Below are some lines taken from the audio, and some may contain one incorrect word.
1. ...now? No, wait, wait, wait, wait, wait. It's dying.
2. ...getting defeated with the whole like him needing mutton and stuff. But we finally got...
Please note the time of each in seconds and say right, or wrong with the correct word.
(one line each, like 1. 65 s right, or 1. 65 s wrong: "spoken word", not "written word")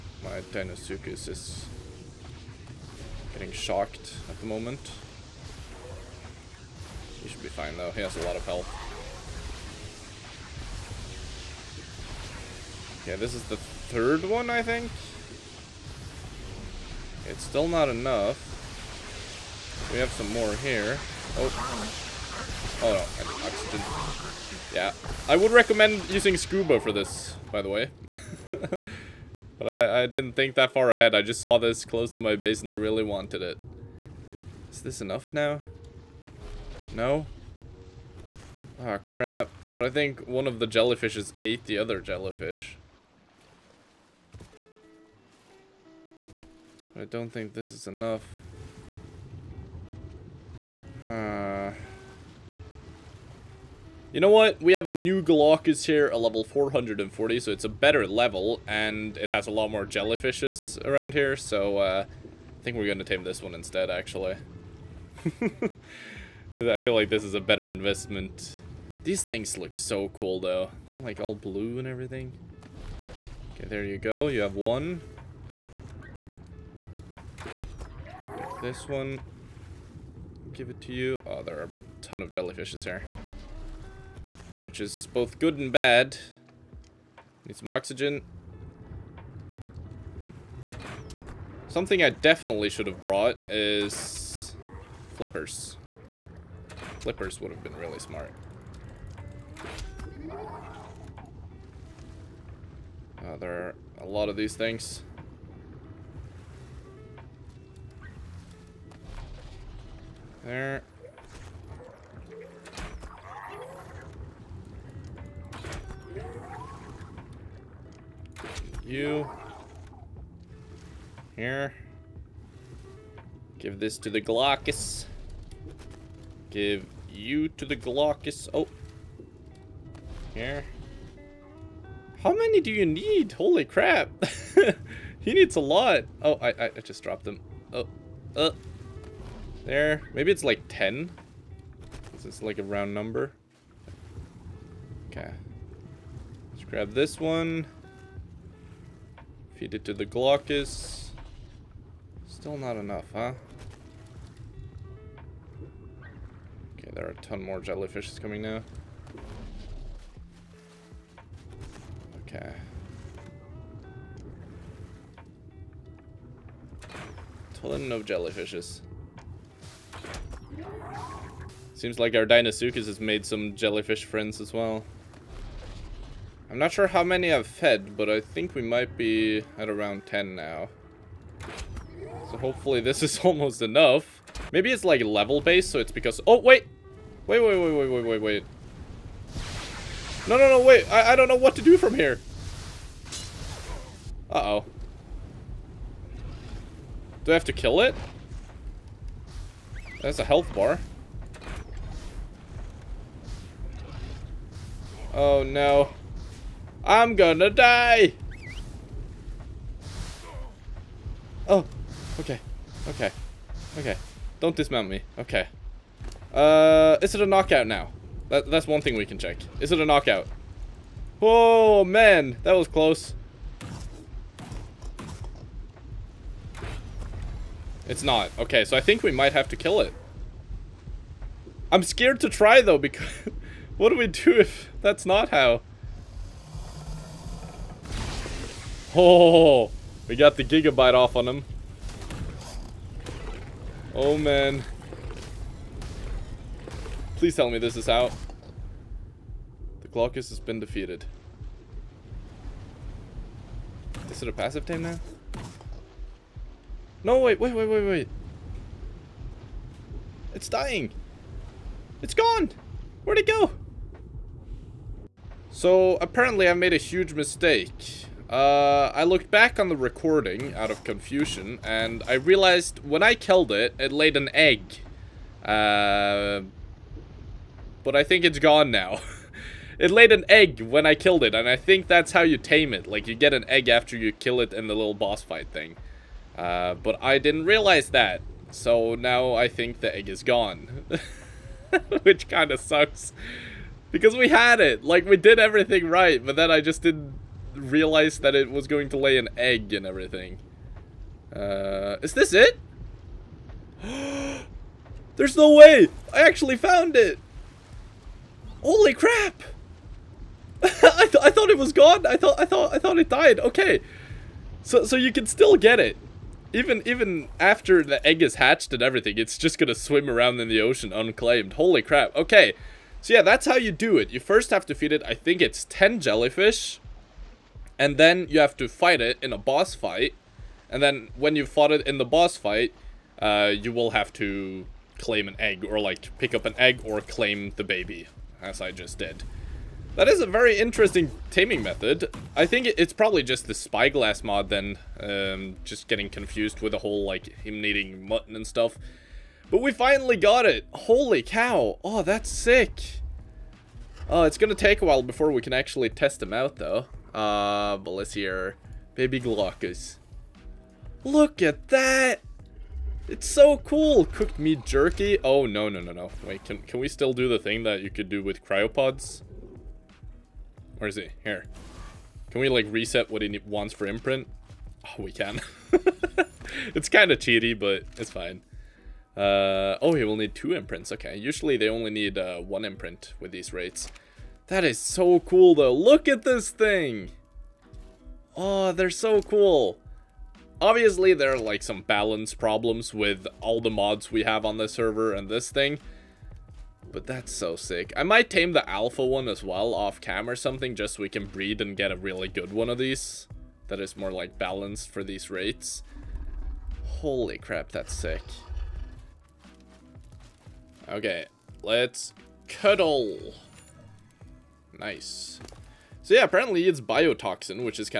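1. 254 s right
2. 345 s wrong: "confused", not "defeated".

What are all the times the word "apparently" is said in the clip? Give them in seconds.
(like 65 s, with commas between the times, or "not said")
265 s, 416 s.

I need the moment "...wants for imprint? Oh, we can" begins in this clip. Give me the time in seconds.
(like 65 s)
373 s.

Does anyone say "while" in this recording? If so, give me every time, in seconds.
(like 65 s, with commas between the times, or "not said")
354 s.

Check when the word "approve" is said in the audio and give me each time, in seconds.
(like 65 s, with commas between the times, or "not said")
not said.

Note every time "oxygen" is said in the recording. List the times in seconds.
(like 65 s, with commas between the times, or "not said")
23 s, 87 s.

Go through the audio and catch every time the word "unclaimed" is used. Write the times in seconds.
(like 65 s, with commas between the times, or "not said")
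320 s.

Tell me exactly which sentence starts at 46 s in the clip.
I don't think this is enough.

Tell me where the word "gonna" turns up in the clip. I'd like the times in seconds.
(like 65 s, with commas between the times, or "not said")
207 s, 354 s.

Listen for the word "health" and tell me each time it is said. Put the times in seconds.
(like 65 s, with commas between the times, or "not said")
8 s, 200 s.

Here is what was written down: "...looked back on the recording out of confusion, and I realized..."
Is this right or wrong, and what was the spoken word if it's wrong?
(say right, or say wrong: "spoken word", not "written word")
right.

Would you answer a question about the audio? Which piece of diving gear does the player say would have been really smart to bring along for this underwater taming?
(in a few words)
Flippers.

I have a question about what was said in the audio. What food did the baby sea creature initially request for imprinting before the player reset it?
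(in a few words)
Cooked meat jerky.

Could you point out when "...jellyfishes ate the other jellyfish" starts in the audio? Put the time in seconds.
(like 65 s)
40 s.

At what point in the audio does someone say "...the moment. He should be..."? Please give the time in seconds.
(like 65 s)
4 s.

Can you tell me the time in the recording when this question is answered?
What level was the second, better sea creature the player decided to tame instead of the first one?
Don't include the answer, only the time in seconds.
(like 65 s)
56 s.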